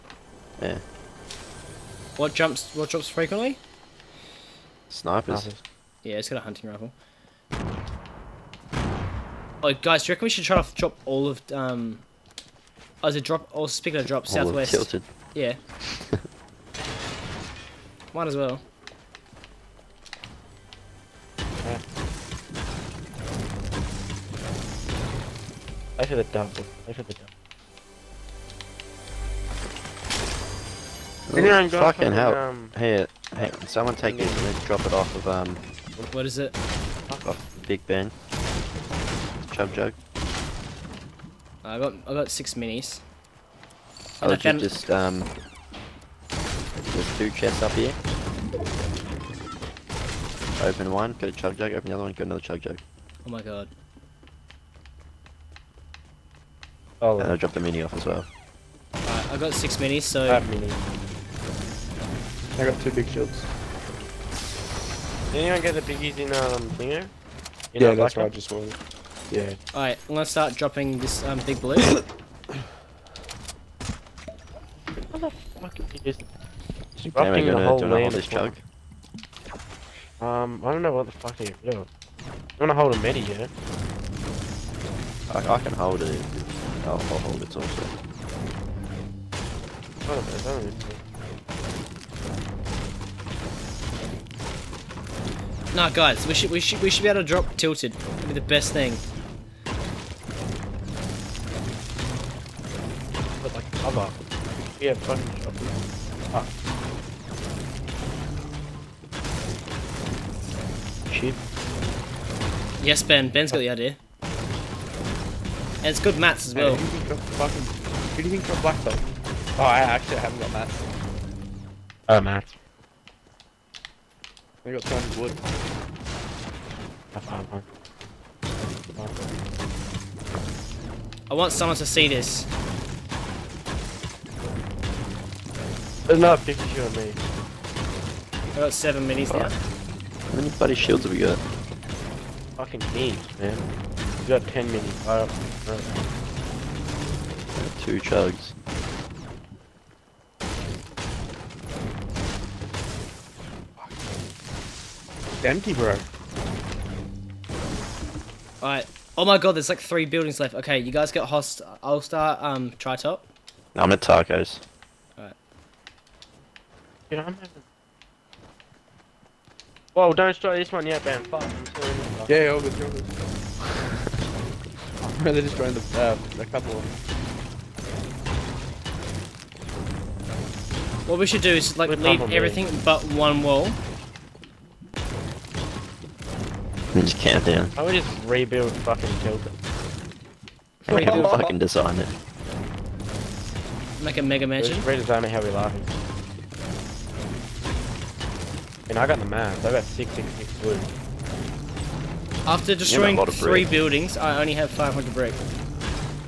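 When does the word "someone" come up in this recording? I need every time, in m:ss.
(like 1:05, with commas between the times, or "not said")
0:33, 2:11.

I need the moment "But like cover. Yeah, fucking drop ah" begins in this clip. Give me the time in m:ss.
1:43.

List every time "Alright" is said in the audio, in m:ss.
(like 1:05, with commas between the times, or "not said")
1:09, 2:25, 2:38, 2:45.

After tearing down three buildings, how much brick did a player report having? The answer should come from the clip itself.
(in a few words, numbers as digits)
500.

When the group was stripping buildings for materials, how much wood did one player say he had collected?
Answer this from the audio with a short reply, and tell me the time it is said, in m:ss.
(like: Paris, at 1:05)
666, at 3:19.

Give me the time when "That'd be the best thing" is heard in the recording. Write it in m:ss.
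1:37.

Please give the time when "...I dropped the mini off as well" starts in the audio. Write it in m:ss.
0:57.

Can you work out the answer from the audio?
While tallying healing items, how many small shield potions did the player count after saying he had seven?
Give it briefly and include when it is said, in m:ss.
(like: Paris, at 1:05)
10, at 2:24.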